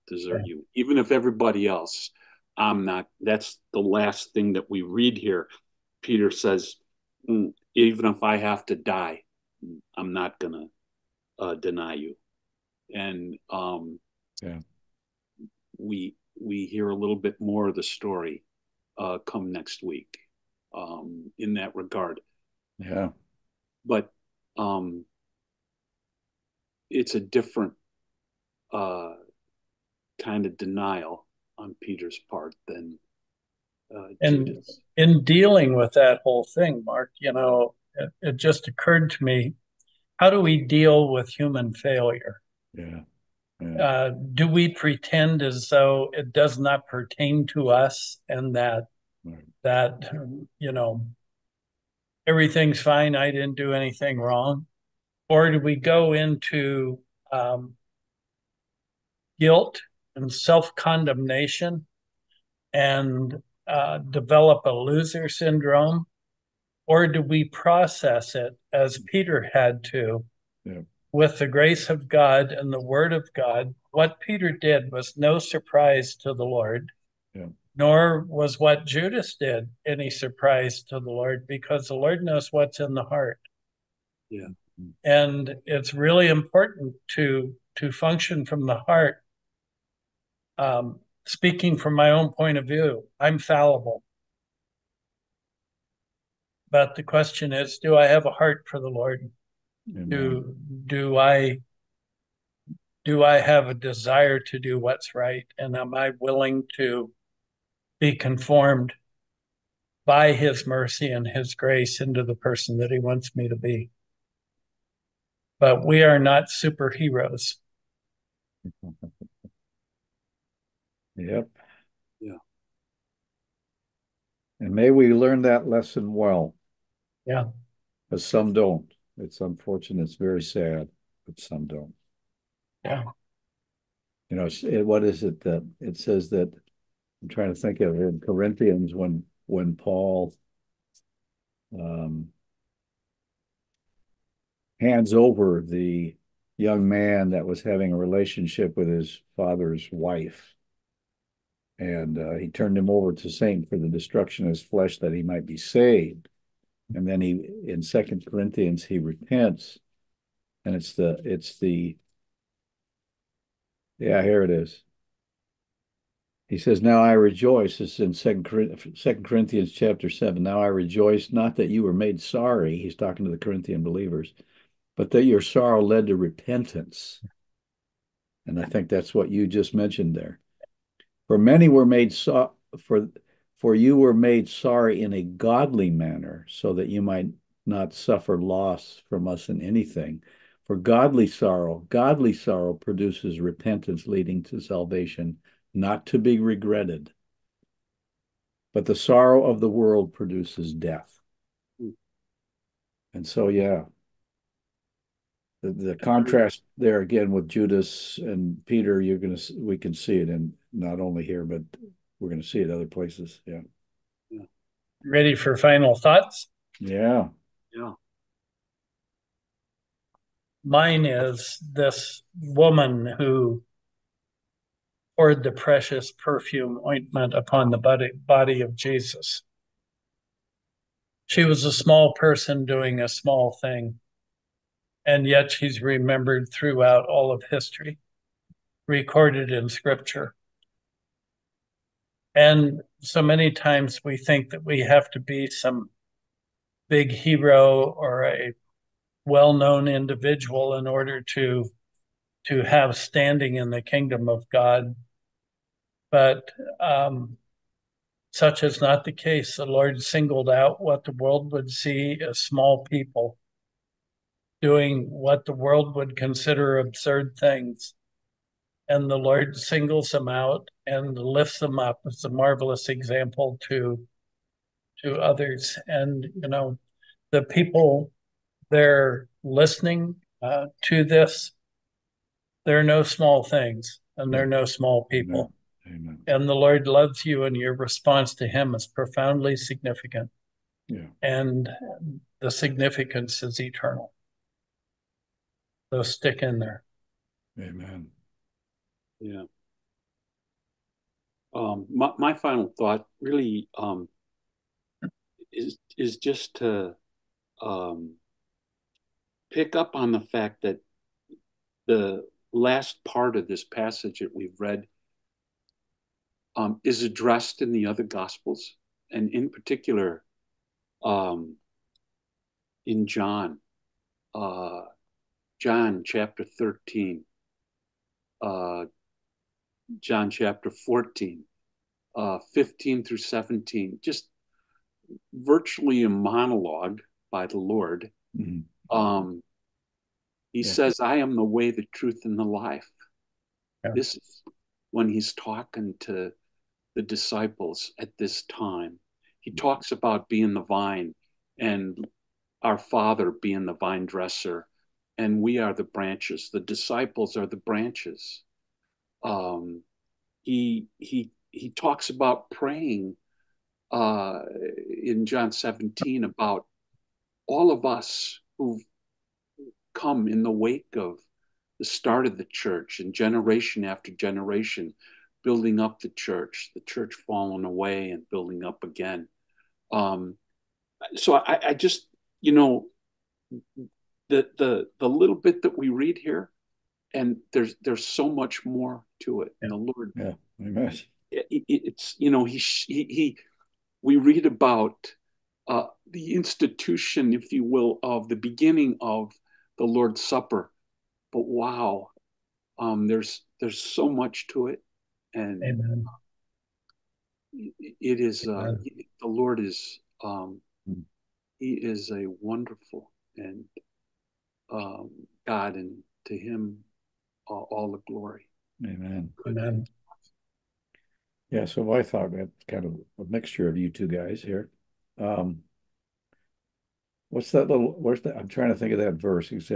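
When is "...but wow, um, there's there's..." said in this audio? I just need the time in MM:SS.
06:41.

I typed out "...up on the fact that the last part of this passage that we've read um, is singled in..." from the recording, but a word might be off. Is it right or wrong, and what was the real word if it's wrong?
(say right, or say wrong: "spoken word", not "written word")
wrong: "addressed", not "singled".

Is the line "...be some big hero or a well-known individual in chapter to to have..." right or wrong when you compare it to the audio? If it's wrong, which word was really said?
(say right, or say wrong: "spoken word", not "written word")
wrong: "order", not "chapter".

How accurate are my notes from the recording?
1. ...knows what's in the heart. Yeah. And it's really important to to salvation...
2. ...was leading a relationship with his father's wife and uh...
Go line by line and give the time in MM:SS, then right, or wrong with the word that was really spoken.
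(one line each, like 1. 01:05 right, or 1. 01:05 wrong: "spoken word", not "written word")
1. 01:22 wrong: "function", not "salvation"
2. 02:27 wrong: "having", not "leading".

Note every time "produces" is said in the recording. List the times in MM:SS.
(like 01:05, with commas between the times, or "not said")
03:12, 03:20.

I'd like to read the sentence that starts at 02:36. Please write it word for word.
And then he, in Second Corinthians, he repents, and it's the it's the yeah here it is.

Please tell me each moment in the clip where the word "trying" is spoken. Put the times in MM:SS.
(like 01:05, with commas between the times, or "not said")
02:17, 07:08.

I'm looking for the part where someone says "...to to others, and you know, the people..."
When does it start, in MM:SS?
04:33.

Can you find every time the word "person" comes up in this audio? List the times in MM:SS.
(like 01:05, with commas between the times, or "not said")
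01:52, 03:52.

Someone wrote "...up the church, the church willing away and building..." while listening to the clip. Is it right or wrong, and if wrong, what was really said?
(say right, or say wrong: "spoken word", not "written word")
wrong: "falling", not "willing".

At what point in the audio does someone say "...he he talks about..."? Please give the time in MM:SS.
06:00.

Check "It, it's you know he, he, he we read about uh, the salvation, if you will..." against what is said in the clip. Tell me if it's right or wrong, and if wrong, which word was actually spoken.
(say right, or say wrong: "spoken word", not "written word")
wrong: "institution", not "salvation".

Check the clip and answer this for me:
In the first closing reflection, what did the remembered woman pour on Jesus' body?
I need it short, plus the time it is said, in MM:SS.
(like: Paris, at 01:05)
perfume ointment, at 03:46.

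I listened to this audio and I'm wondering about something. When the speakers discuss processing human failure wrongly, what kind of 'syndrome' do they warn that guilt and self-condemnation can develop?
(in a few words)
loser syndrome.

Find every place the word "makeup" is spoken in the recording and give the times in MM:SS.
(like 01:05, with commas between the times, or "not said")
not said.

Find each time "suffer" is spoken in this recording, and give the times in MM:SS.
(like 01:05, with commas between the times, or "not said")
03:07.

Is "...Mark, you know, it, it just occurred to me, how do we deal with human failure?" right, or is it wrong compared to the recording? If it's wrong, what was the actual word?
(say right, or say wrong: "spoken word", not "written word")
right.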